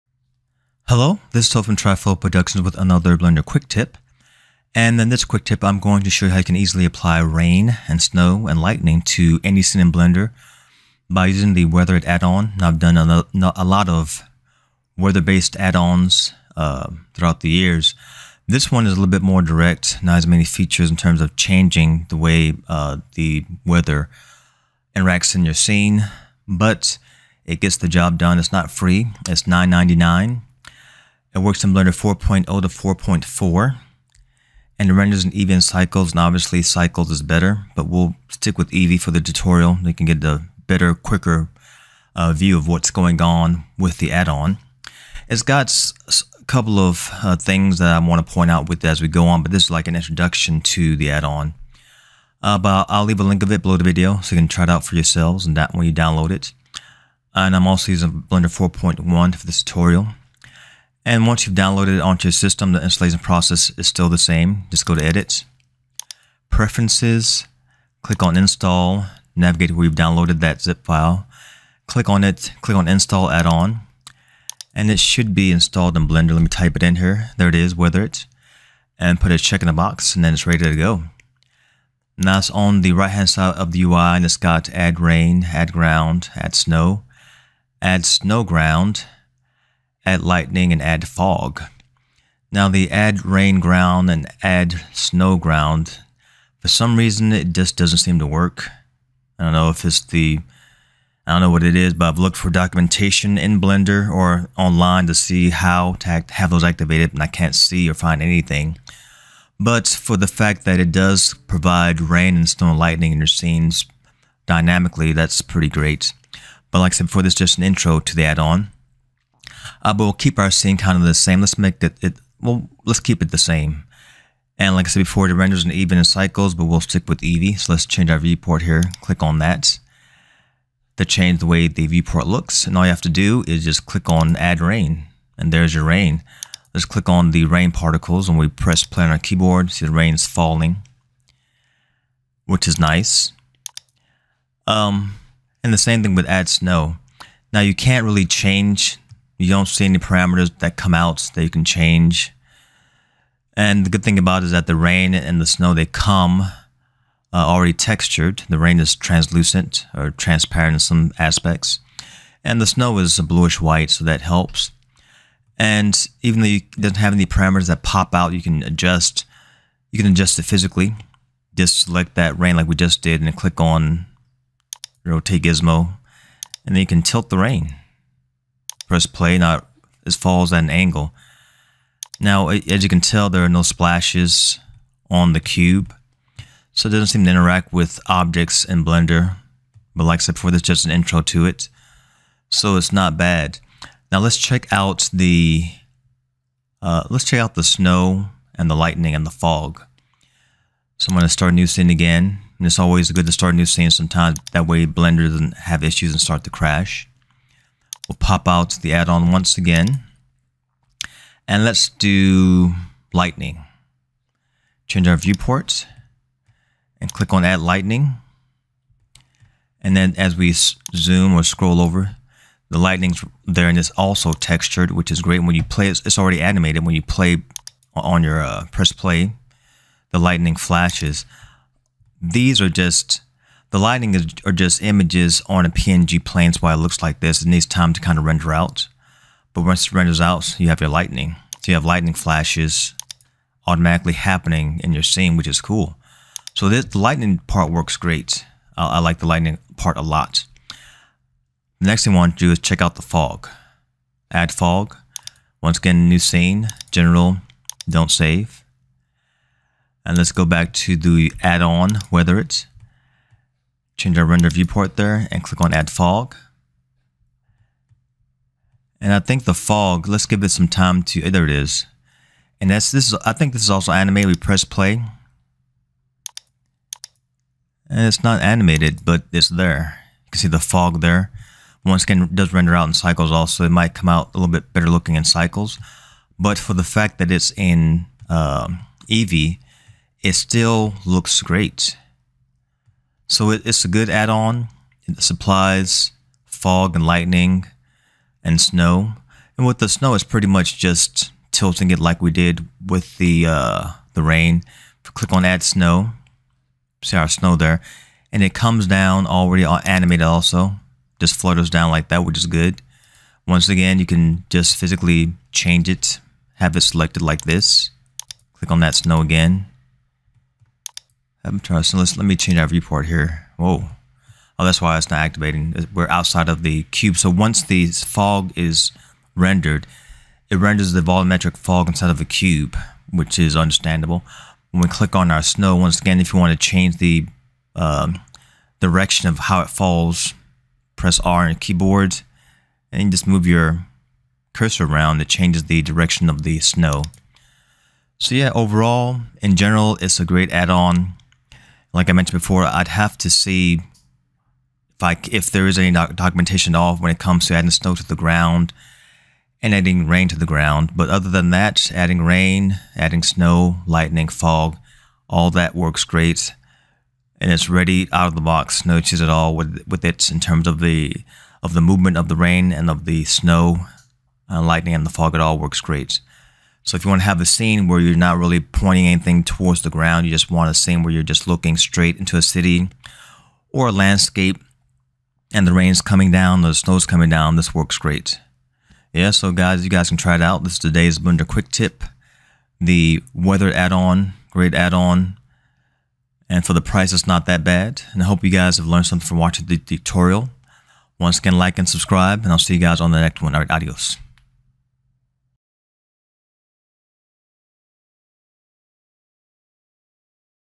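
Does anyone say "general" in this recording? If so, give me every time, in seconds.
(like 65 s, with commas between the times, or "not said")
256 s, 349 s.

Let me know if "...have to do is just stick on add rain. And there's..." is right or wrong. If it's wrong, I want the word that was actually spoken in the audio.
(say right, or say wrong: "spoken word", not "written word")
wrong: "click", not "stick".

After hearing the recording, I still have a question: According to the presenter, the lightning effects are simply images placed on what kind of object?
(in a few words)
A PNG plane.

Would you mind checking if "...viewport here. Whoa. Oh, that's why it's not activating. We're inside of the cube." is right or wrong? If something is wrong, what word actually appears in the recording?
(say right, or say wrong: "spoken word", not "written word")
wrong: "outside", not "inside".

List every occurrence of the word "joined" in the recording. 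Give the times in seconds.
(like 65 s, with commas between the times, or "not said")
not said.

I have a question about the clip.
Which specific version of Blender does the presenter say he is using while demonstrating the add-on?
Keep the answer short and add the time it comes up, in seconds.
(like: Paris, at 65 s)
Blender 4.1, at 58 s.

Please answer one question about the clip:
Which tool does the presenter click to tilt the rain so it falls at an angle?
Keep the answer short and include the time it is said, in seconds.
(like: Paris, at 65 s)
Rotate Gizmo, at 175 s.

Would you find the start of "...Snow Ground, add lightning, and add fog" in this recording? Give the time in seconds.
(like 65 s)
88 s.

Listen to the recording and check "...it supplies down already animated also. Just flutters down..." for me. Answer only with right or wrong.
wrong.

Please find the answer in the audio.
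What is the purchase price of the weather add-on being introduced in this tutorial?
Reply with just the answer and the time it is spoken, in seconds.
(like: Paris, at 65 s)
$9.99, at 29 s.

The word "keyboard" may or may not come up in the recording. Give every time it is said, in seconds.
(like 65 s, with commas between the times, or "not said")
139 s, 341 s.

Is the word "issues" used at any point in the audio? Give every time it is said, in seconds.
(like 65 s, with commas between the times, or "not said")
205 s, 368 s.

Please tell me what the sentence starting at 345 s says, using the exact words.
It changes the direction of the snow.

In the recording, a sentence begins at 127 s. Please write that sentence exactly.
So let's change our viewport here.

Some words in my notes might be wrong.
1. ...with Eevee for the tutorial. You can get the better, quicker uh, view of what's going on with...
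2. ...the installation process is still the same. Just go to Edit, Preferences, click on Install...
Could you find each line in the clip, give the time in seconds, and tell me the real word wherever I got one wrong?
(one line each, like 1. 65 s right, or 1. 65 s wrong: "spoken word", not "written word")
1. 38 s right
2. 62 s right.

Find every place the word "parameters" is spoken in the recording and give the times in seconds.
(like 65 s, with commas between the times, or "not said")
149 s, 167 s.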